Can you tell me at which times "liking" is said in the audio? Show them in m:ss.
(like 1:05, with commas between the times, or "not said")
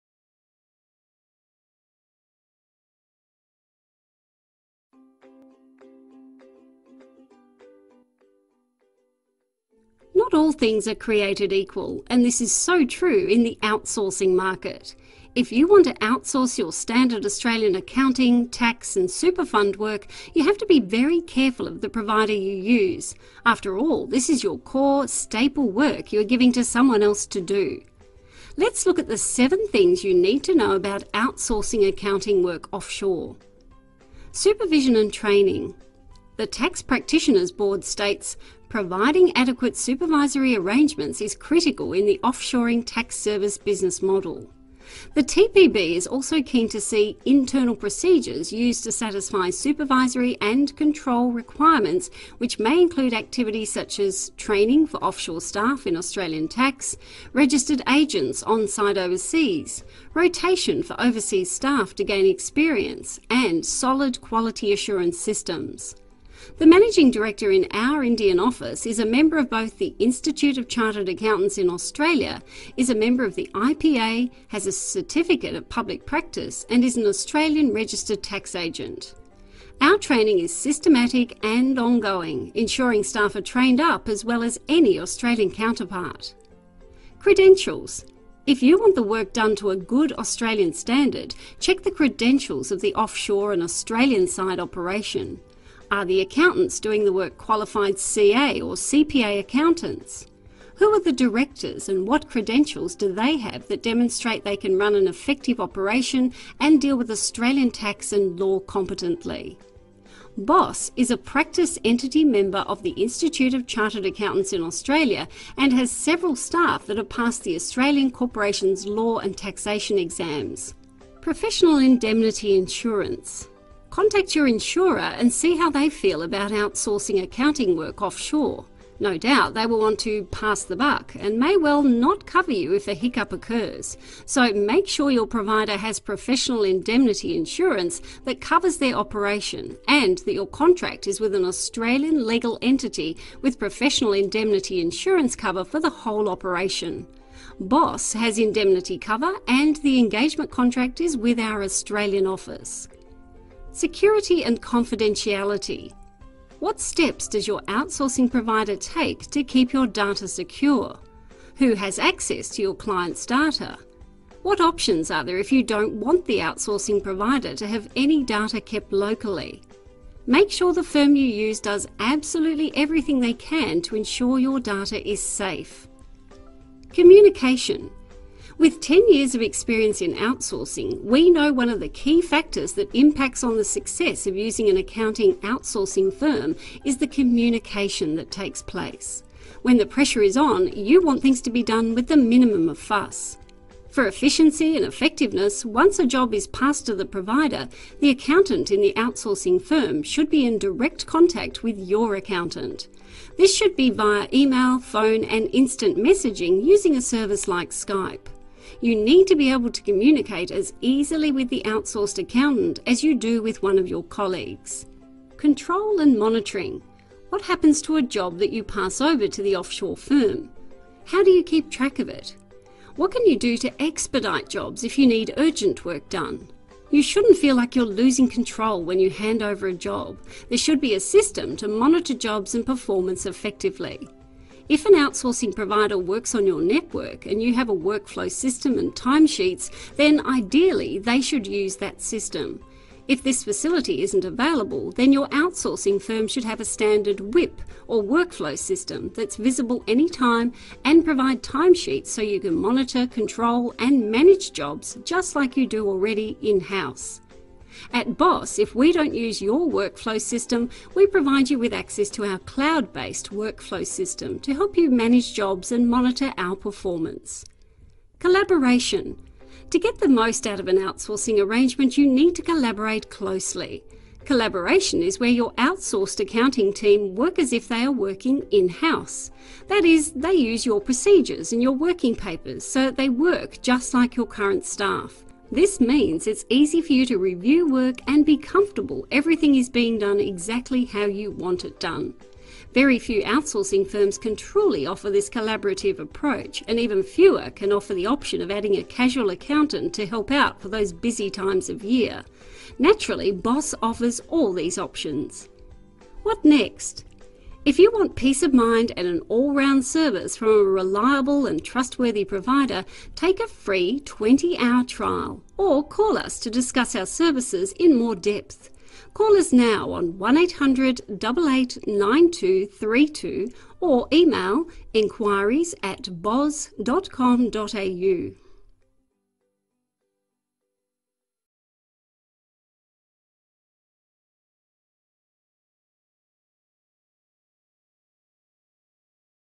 not said.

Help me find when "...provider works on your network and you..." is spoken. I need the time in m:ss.
3:55.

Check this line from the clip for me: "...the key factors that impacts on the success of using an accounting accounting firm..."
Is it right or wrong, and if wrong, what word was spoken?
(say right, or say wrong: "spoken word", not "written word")
wrong: "outsourcing", not "accounting".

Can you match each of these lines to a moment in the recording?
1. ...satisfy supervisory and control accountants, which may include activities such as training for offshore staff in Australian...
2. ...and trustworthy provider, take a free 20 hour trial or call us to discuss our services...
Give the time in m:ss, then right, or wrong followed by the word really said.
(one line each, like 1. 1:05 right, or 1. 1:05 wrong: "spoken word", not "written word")
1. 0:48 wrong: "requirements", not "accountants"
2. 5:11 right.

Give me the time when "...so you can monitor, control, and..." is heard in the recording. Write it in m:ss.
4:12.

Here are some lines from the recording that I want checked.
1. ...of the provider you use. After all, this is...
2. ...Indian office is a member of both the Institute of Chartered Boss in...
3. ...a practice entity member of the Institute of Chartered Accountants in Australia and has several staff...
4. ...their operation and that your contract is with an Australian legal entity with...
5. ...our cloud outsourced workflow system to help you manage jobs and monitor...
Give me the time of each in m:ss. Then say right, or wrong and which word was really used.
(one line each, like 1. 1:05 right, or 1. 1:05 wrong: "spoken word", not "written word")
1. 0:21 right
2. 1:08 wrong: "Accountants", not "Boss"
3. 1:51 right
4. 2:18 right
5. 4:22 wrong: "based", not "outsourced".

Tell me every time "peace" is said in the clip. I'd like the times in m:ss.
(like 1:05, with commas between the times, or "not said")
5:08.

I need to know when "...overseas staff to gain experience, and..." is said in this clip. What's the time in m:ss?
1:00.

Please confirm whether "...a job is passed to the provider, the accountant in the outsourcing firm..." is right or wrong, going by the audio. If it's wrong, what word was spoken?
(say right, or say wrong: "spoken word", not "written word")
right.